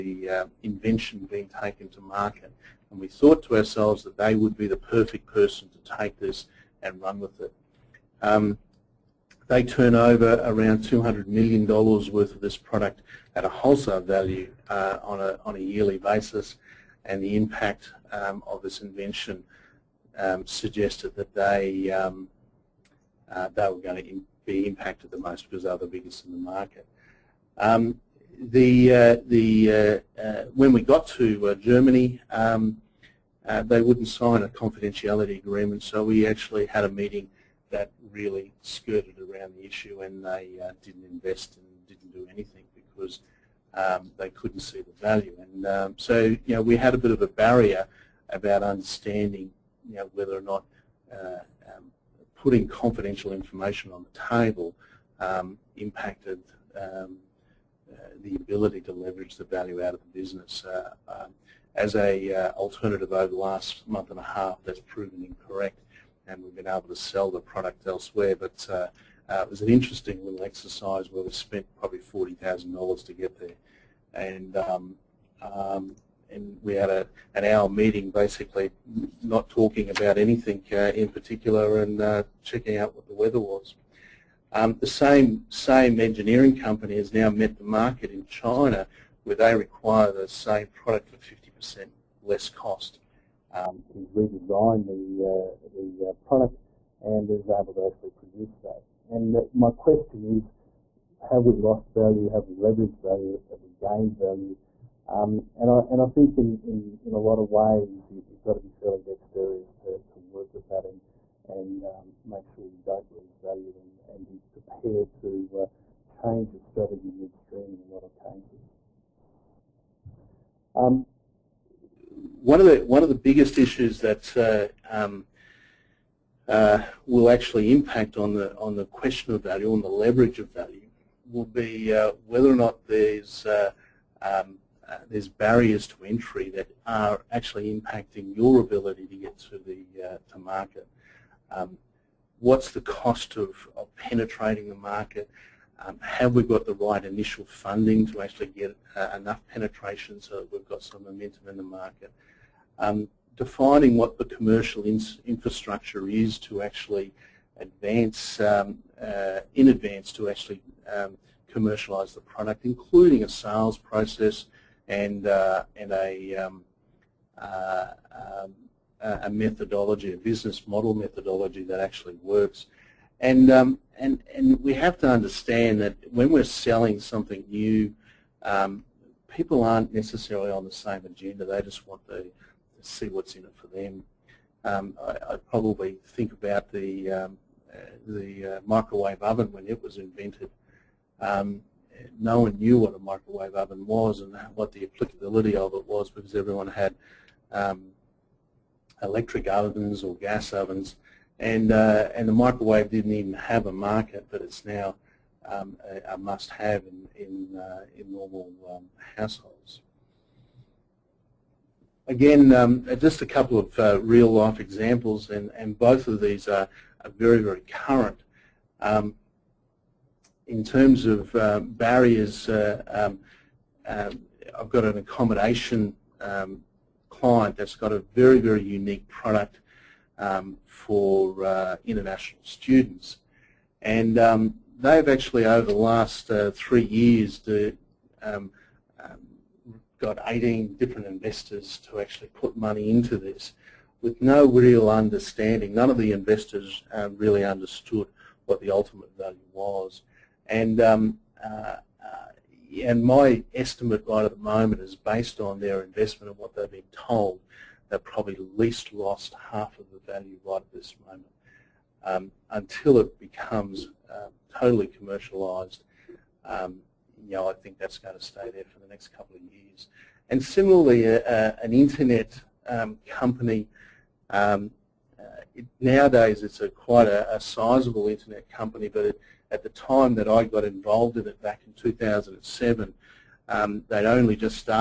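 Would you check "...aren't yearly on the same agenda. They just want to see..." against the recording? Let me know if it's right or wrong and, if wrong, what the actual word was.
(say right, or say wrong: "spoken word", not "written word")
wrong: "necessarily", not "yearly".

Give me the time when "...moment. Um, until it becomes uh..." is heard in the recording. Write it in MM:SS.
04:21.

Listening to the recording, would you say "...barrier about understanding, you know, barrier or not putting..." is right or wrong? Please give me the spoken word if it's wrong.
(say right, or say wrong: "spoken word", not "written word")
wrong: "whether", not "barrier".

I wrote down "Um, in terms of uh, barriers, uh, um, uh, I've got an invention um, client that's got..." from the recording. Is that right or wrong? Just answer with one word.
wrong.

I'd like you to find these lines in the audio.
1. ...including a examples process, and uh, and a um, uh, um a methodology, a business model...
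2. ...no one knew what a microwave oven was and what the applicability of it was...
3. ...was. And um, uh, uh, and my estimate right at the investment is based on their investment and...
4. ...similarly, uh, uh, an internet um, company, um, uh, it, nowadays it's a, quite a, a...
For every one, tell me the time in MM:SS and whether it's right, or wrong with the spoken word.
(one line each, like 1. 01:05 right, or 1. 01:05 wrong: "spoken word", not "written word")
1. 02:42 wrong: "sales", not "examples"
2. 03:12 right
3. 04:09 wrong: "moment", not "investment"
4. 04:30 right.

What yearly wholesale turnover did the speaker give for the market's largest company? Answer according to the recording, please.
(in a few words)
$200 million.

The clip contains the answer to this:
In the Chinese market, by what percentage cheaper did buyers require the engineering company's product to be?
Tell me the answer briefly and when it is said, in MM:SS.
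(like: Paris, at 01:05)
50%, at 01:31.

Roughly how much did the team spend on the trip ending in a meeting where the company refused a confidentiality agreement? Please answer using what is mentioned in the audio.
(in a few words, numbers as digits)
$40,000.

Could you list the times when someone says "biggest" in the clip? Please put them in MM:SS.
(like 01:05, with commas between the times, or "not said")
00:25, 02:03.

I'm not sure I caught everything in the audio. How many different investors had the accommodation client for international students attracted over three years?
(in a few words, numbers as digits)
18.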